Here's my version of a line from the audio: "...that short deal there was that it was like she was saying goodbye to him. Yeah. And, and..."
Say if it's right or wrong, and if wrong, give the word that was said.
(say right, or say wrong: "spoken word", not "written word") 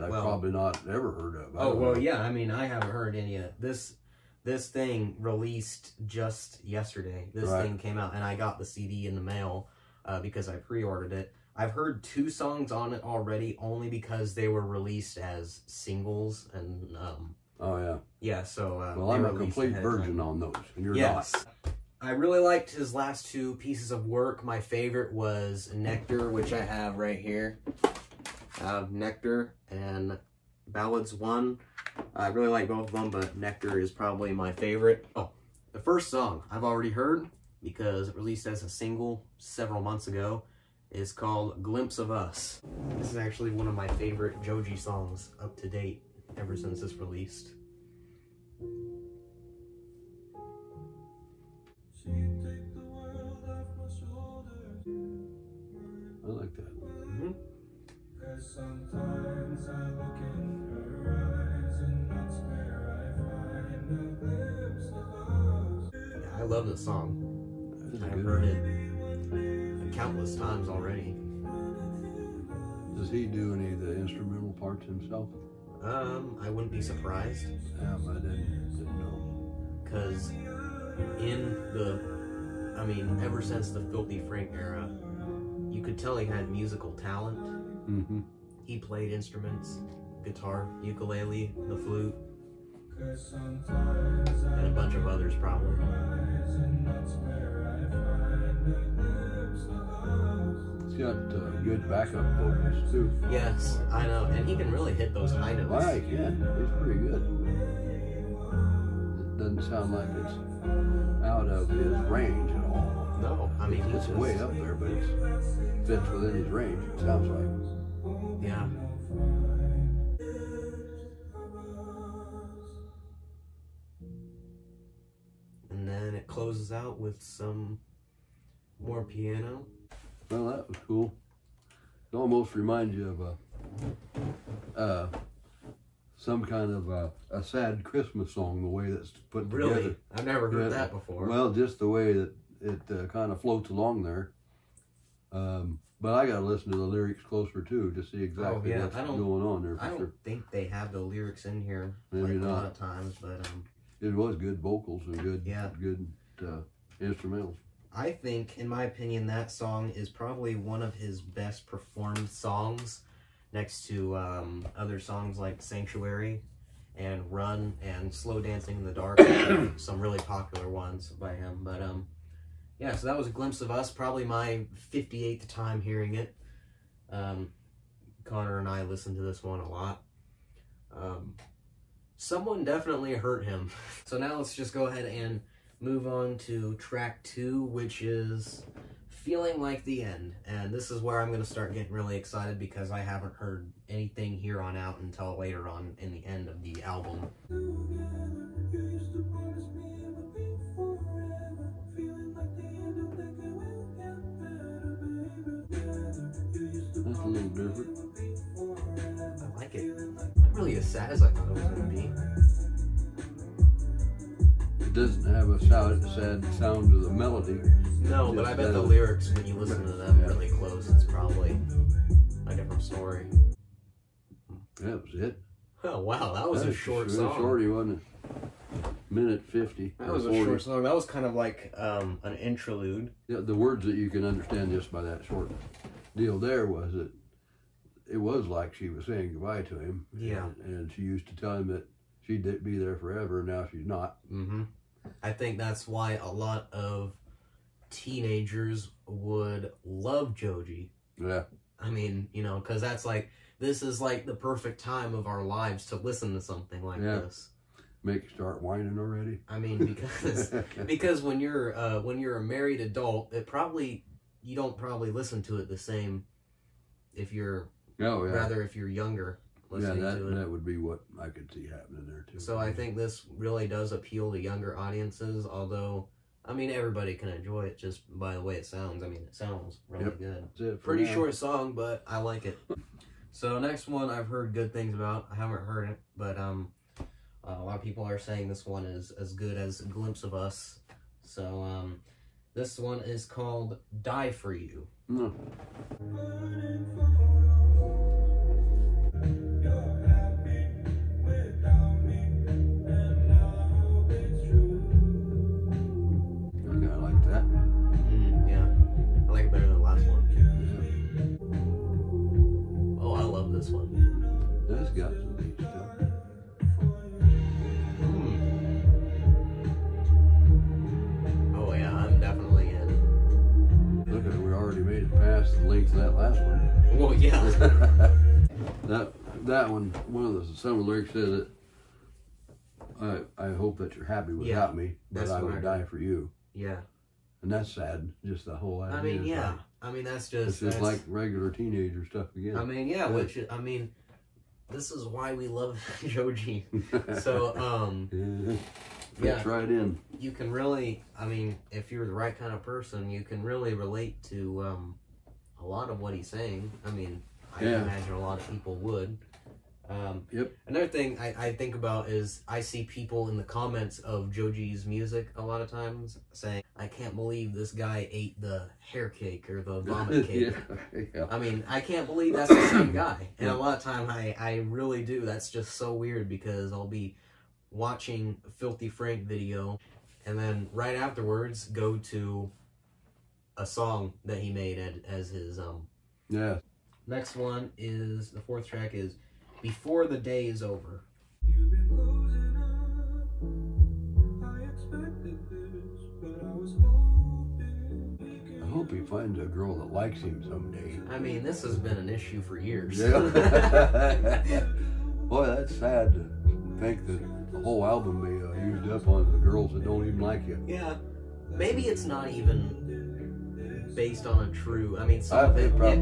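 right.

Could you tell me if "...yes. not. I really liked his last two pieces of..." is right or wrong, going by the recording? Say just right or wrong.
right.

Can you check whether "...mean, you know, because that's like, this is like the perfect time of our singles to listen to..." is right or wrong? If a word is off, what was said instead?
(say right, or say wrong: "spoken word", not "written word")
wrong: "lives", not "singles".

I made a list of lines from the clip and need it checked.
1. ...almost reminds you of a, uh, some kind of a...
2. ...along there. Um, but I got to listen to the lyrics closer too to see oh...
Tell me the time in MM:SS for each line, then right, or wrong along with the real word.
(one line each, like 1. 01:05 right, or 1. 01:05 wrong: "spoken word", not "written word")
1. 02:12 right
2. 02:23 right.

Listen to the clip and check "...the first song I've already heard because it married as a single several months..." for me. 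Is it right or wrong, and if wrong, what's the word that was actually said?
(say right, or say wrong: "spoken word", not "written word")
wrong: "released", not "married".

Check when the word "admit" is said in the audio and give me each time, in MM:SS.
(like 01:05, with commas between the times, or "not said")
not said.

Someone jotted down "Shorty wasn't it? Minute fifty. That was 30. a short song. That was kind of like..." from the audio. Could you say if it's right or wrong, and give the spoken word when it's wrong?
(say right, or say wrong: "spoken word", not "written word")
wrong: "40", not "30".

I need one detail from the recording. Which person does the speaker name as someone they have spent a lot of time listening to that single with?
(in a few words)
Connor.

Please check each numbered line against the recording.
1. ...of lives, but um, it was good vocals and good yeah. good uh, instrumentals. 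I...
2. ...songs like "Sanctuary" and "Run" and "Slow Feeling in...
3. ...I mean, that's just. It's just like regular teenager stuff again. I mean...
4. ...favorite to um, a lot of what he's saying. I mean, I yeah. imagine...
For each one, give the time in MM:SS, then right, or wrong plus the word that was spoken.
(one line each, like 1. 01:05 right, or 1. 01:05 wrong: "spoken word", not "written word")
1. 02:32 wrong: "times", not "lives"
2. 02:44 wrong: "Dancing", not "Feeling"
3. 05:39 right
4. 05:53 wrong: "relate", not "favorite".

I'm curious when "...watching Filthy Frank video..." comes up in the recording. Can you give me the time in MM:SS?
06:17.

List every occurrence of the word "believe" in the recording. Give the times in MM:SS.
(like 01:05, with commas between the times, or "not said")
06:07, 06:12.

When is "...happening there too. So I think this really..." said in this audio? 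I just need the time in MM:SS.
04:31.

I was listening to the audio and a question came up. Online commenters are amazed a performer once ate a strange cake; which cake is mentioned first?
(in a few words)
hair cake.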